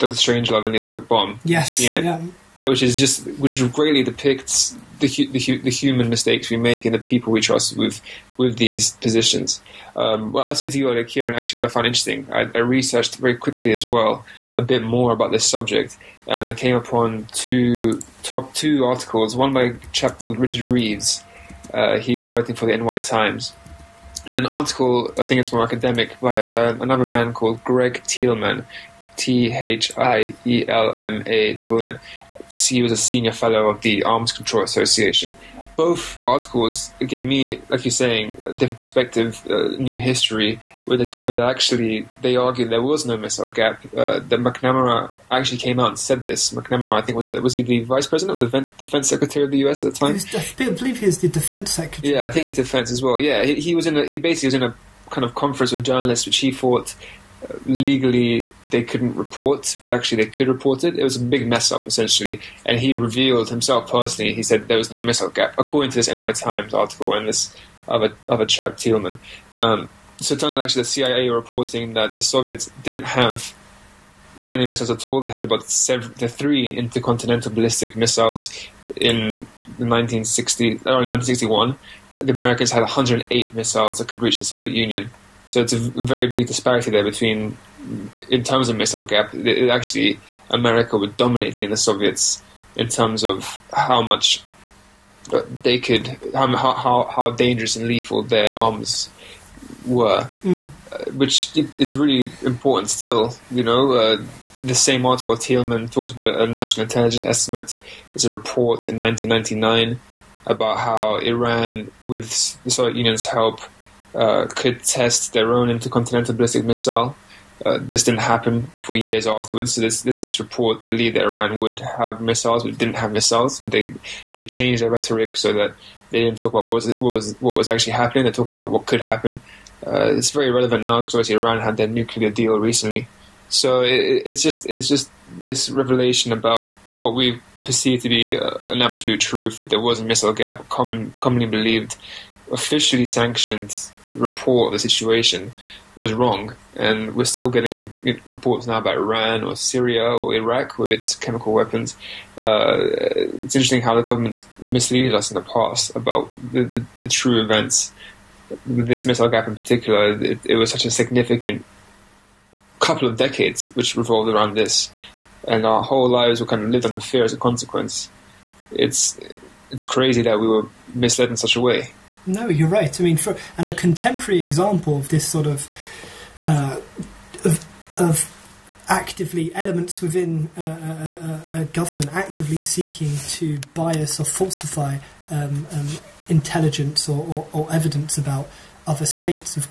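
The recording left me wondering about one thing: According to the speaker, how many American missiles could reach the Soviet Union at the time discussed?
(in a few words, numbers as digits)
108.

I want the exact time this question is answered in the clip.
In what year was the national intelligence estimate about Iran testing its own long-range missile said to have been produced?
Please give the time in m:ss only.
1:48.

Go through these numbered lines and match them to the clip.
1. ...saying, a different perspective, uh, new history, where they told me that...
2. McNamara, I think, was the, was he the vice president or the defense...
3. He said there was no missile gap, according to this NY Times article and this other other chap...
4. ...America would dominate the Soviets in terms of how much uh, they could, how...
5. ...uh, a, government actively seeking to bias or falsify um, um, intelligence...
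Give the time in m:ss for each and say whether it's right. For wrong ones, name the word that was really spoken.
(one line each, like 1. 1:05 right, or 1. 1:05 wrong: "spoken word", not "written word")
1. 0:37 right
2. 0:46 right
3. 1:04 right
4. 1:30 right
5. 3:01 right.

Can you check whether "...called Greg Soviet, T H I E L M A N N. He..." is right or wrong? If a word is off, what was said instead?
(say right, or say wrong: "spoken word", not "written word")
wrong: "Thielmann", not "Soviet".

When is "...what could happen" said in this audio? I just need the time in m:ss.
2:08.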